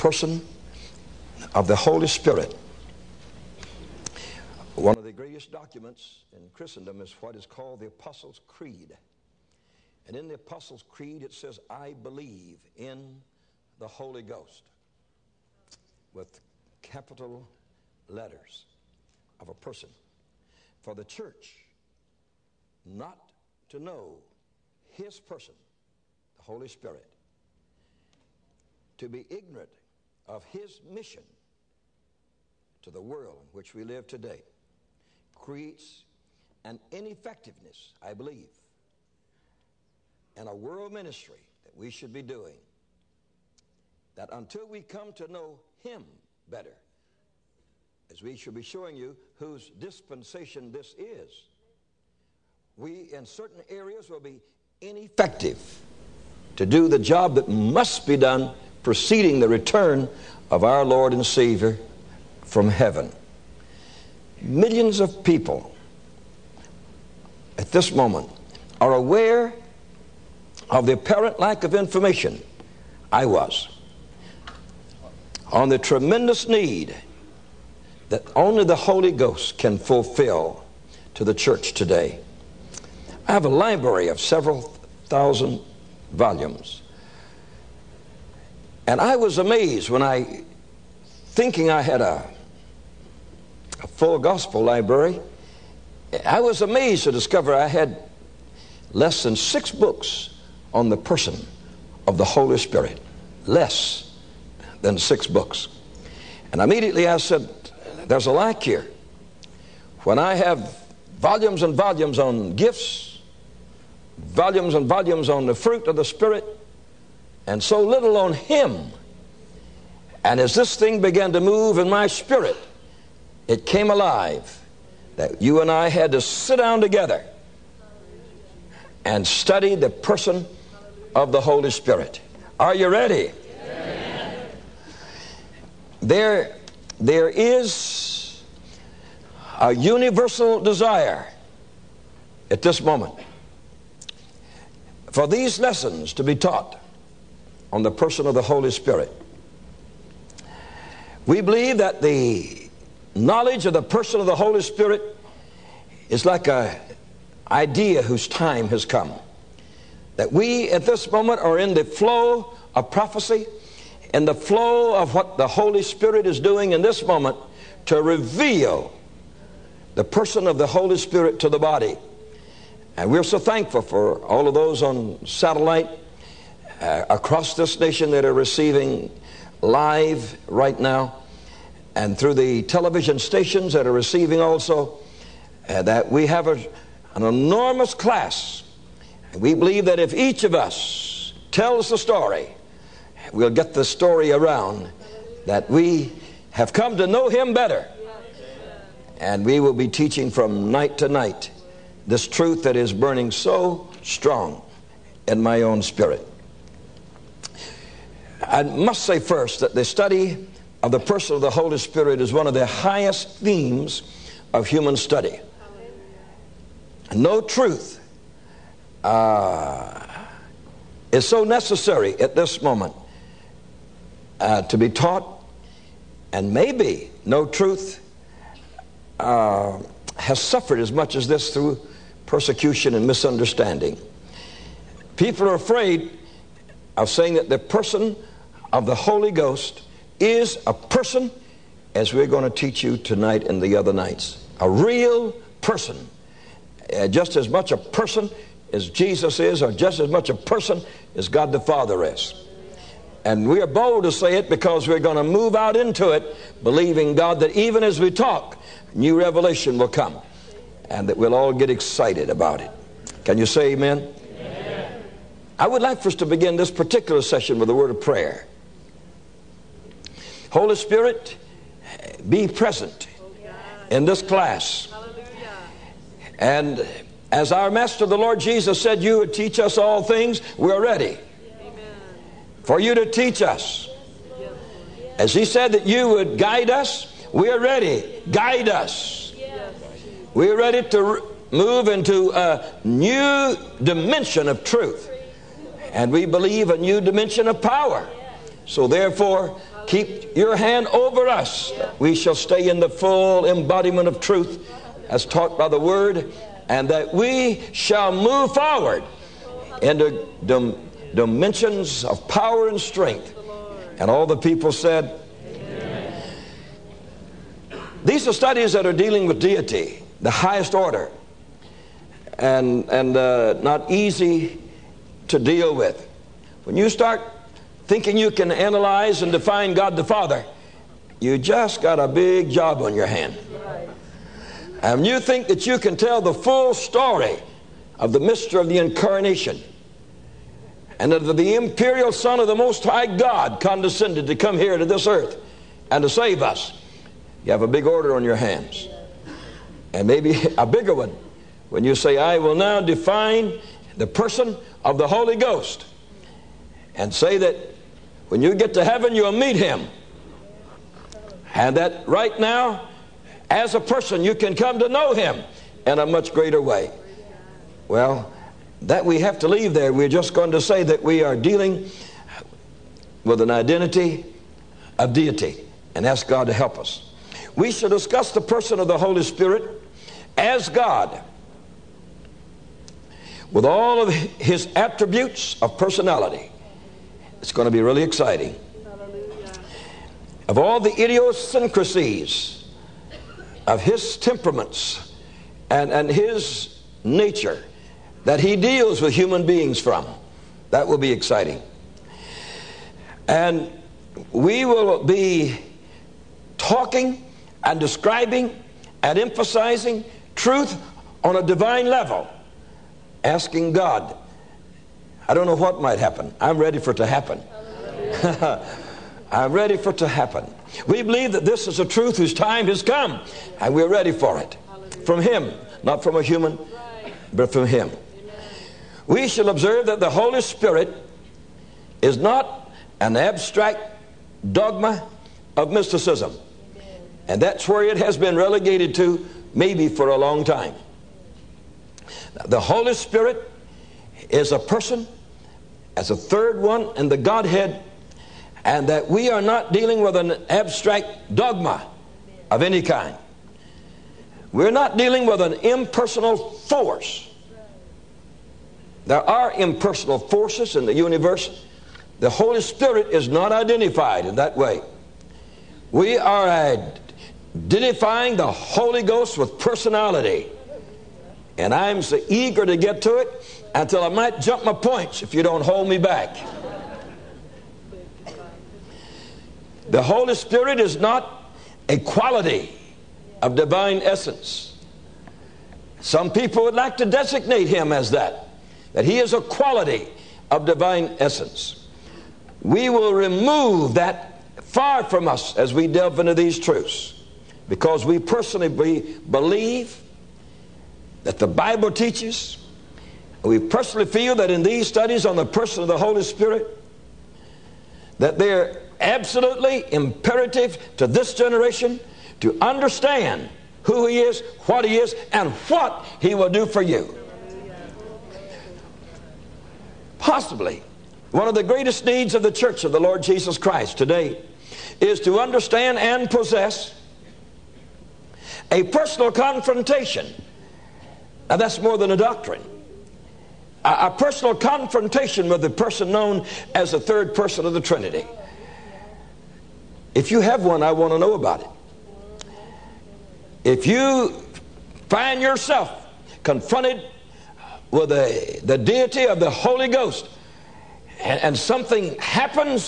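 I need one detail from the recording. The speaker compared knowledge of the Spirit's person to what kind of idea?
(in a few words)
an idea whose time has come.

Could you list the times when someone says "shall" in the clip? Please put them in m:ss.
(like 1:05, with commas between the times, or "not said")
0:48, 5:02, 5:07, 6:17, 7:09.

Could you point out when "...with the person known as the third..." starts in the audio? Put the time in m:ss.
8:55.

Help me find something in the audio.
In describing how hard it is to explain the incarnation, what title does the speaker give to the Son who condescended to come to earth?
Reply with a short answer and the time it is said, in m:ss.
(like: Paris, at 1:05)
imperial Son, at 5:41.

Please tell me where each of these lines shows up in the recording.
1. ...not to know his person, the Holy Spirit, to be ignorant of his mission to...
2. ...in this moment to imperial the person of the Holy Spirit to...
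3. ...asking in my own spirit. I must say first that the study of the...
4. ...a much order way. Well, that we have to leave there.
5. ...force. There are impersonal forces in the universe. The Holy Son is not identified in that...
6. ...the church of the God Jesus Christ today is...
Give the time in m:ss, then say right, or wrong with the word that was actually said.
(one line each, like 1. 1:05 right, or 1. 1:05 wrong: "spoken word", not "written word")
1. 0:22 right
2. 2:46 wrong: "reveal", not "imperial"
3. 3:24 wrong: "strong", not "asking"
4. 6:05 wrong: "greater", not "order"
5. 7:36 wrong: "Spirit", not "Son"
6. 8:42 wrong: "Lord", not "God".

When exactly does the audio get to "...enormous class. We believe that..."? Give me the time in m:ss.
3:07.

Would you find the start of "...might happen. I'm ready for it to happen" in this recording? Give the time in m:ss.
6:55.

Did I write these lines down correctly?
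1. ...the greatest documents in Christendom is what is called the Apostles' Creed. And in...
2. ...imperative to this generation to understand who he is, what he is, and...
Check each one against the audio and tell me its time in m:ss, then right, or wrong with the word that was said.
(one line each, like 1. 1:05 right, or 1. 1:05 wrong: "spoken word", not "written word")
1. 0:05 right
2. 8:29 right.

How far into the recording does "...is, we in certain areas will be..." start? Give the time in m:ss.
0:50.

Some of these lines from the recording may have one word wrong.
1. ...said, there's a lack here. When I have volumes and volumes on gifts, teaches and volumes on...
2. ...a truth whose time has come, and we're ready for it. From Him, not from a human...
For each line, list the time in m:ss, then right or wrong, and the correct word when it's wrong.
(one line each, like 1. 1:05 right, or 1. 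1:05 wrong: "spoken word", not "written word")
1. 1:47 wrong: "volumes", not "teaches"
2. 7:01 right.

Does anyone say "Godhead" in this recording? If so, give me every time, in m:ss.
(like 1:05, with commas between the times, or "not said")
7:27.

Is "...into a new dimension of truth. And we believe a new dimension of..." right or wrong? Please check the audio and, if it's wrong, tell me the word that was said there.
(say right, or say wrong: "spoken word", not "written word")
right.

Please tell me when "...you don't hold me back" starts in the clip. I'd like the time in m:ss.
7:55.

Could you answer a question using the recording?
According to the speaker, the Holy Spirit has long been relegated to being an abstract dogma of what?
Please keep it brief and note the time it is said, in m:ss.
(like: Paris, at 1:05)
mysticism, at 7:15.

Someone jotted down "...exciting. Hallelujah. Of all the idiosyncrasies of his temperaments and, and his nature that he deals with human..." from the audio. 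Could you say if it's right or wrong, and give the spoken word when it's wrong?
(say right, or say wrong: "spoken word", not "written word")
right.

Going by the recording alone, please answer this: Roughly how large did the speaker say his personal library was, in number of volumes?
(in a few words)
several thousand volumes.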